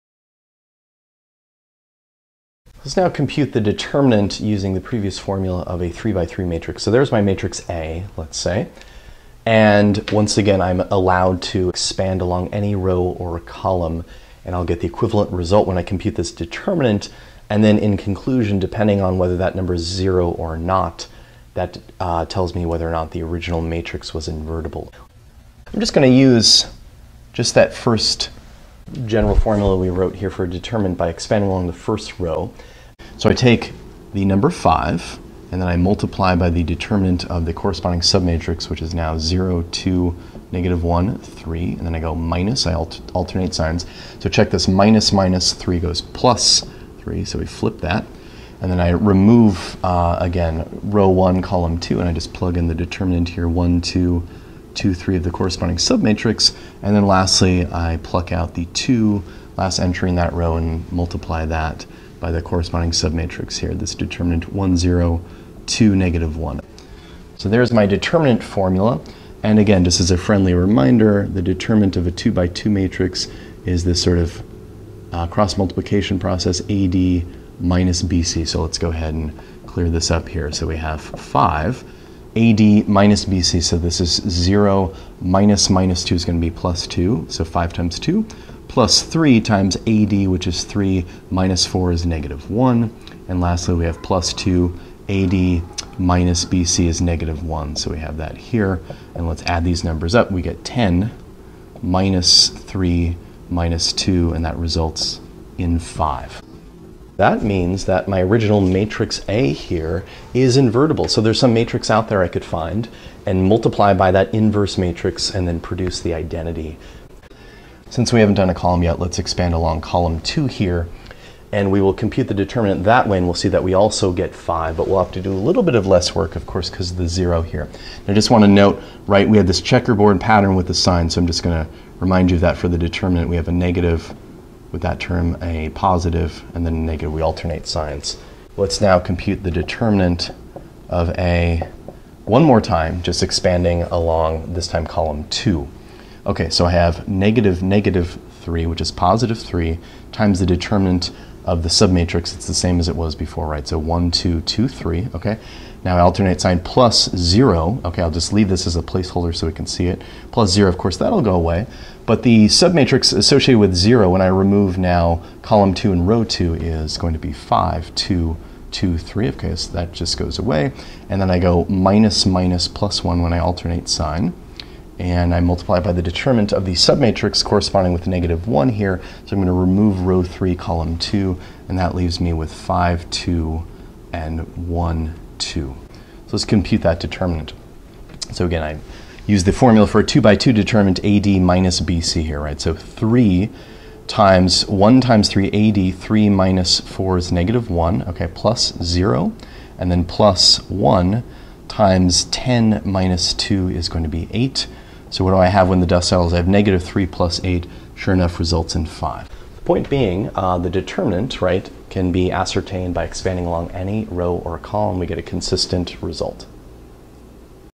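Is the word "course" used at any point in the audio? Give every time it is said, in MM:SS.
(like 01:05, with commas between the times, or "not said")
02:06, 02:40.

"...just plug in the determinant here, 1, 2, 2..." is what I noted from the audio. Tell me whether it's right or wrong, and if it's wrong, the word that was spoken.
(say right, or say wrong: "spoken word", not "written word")
right.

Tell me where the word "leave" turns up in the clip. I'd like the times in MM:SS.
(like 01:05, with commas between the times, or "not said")
02:38, 03:01.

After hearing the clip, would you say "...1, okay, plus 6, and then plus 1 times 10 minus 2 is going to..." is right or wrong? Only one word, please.
wrong.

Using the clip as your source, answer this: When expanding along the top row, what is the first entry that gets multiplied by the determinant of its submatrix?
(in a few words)
5.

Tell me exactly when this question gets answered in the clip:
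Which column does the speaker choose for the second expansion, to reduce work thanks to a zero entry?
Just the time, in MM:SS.
01:59.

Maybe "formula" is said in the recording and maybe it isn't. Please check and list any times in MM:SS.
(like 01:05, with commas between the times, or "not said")
00:05, 00:29, 01:08, 03:09.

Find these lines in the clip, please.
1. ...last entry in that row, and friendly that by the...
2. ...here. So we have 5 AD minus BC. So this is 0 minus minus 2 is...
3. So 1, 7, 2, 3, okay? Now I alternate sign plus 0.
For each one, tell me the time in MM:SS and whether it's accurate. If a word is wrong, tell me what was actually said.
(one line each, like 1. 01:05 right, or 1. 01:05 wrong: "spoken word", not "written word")
1. 00:59 wrong: "multiply", not "friendly"
2. 01:20 right
3. 02:33 wrong: "2", not "7".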